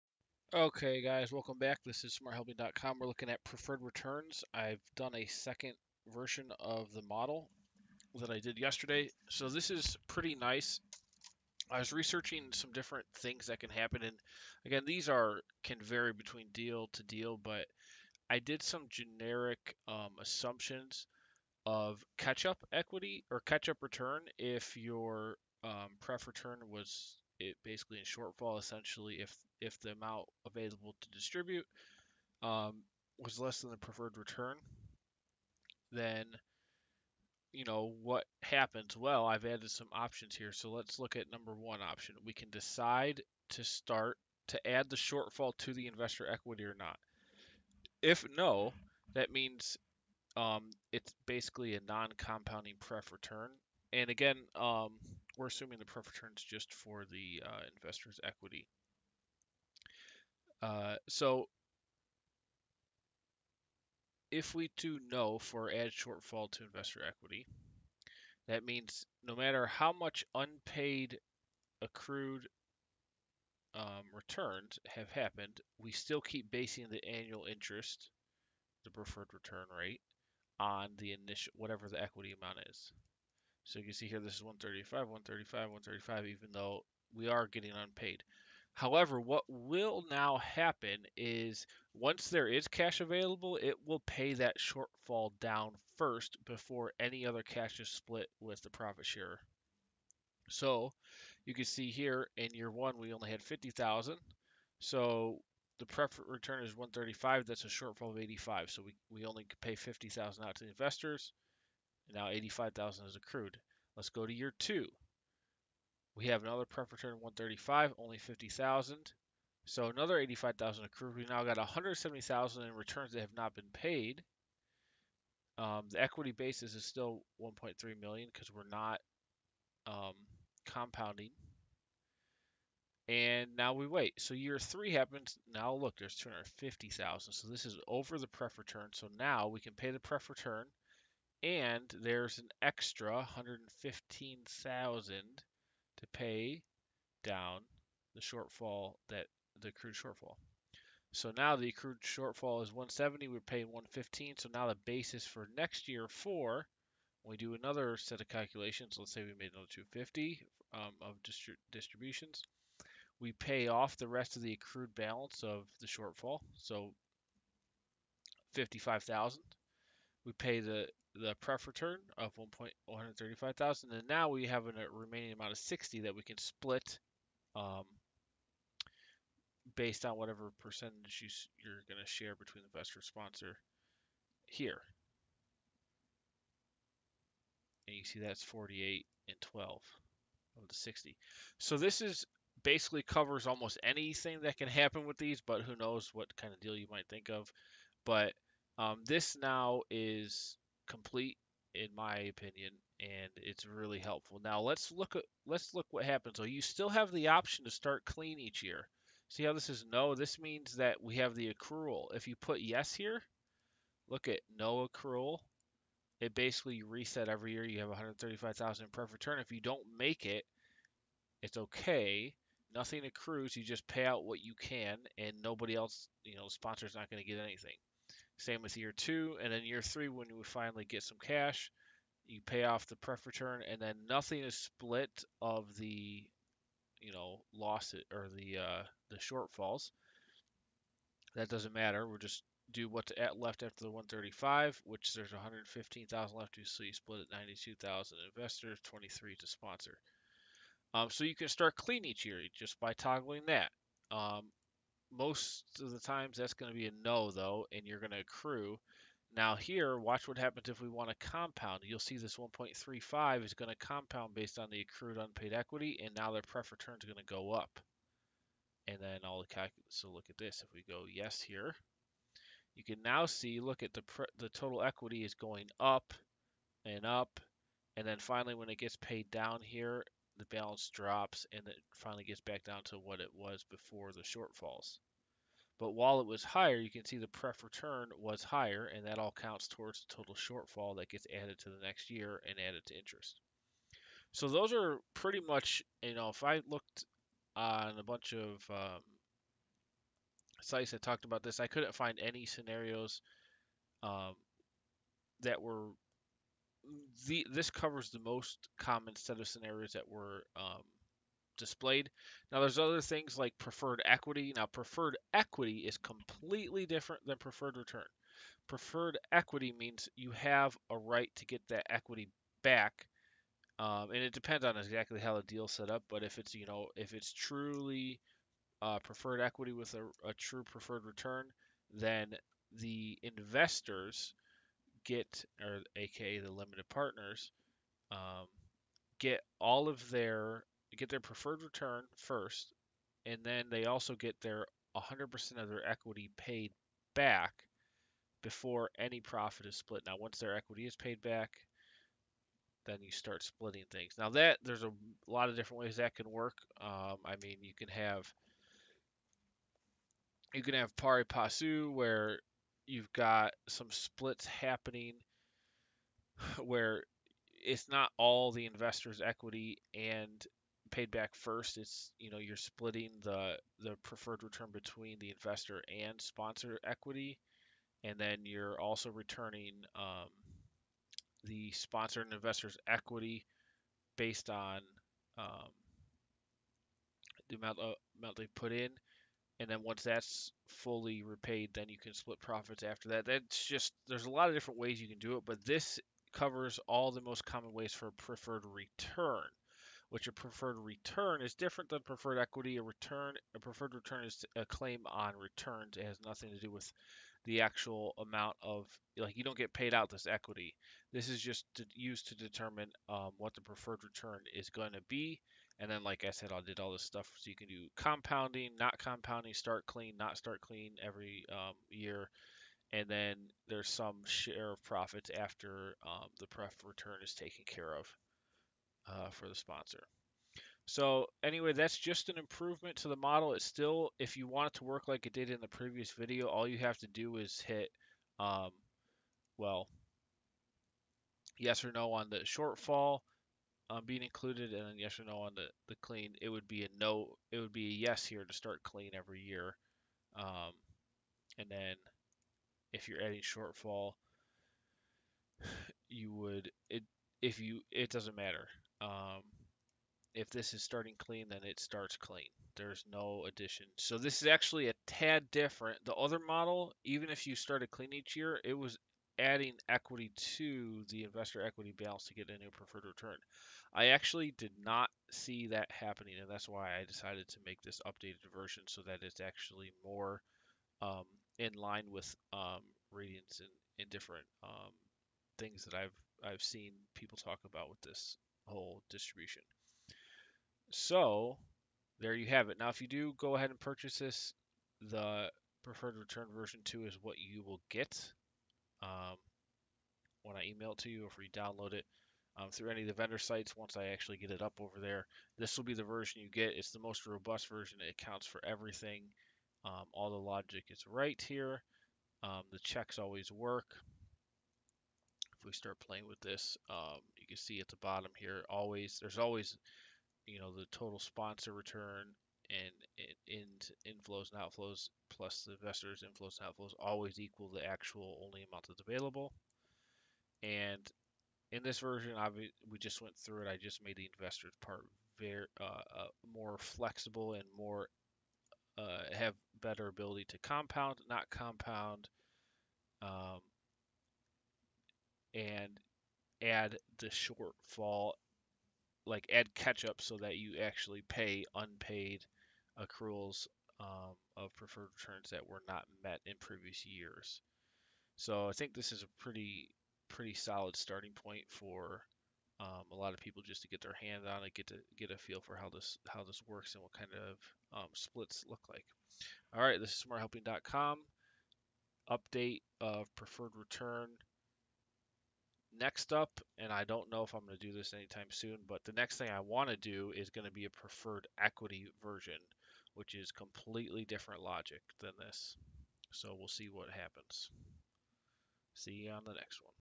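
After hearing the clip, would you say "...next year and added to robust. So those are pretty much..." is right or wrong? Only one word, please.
wrong.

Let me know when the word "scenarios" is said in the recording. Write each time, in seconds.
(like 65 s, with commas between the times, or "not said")
302 s, 309 s.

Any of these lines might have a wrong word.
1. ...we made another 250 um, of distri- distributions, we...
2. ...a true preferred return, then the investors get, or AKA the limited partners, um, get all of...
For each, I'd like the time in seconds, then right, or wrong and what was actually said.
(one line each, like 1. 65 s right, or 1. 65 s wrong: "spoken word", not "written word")
1. 159 s right
2. 330 s right.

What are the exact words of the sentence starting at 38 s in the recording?
Well, I've added some options here, so let's look at number one option.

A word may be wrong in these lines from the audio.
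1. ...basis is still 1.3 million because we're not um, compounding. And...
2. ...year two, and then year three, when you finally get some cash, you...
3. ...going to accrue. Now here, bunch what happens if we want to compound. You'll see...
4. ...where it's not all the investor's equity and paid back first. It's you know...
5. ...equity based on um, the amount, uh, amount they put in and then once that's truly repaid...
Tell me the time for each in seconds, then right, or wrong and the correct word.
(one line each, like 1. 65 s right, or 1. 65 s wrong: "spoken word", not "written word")
1. 126 s right
2. 228 s right
3. 257 s wrong: "watch", not "bunch"
4. 366 s right
5. 382 s wrong: "fully", not "truly".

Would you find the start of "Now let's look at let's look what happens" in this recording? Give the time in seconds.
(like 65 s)
204 s.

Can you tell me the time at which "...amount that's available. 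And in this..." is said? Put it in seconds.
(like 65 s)
528 s.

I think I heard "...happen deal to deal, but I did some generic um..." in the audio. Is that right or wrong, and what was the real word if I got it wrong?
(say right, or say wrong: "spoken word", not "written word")
wrong: "between", not "happen".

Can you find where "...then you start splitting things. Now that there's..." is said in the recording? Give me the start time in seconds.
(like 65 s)
352 s.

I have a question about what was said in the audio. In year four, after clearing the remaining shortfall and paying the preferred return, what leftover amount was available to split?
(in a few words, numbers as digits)
60.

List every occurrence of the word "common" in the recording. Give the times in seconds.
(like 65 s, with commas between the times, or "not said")
308 s, 397 s.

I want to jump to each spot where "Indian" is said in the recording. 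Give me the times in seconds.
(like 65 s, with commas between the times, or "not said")
not said.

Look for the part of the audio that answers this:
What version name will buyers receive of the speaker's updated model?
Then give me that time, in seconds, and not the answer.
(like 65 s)
495 s.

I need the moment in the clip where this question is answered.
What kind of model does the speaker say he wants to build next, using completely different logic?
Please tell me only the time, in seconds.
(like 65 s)
580 s.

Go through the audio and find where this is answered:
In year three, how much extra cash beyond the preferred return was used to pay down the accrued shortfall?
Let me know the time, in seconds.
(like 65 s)
142 s.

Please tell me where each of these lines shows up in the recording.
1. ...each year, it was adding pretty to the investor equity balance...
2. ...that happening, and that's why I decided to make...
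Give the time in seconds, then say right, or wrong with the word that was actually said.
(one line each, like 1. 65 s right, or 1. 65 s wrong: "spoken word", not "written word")
1. 468 s wrong: "equity", not "pretty"
2. 475 s right.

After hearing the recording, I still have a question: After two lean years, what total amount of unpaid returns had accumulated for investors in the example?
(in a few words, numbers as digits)
170,000.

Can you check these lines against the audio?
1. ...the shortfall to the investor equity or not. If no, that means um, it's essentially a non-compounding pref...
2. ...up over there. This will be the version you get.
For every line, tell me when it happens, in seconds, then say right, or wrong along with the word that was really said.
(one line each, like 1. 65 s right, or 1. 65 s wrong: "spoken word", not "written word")
1. 44 s wrong: "basically", not "essentially"
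2. 504 s right.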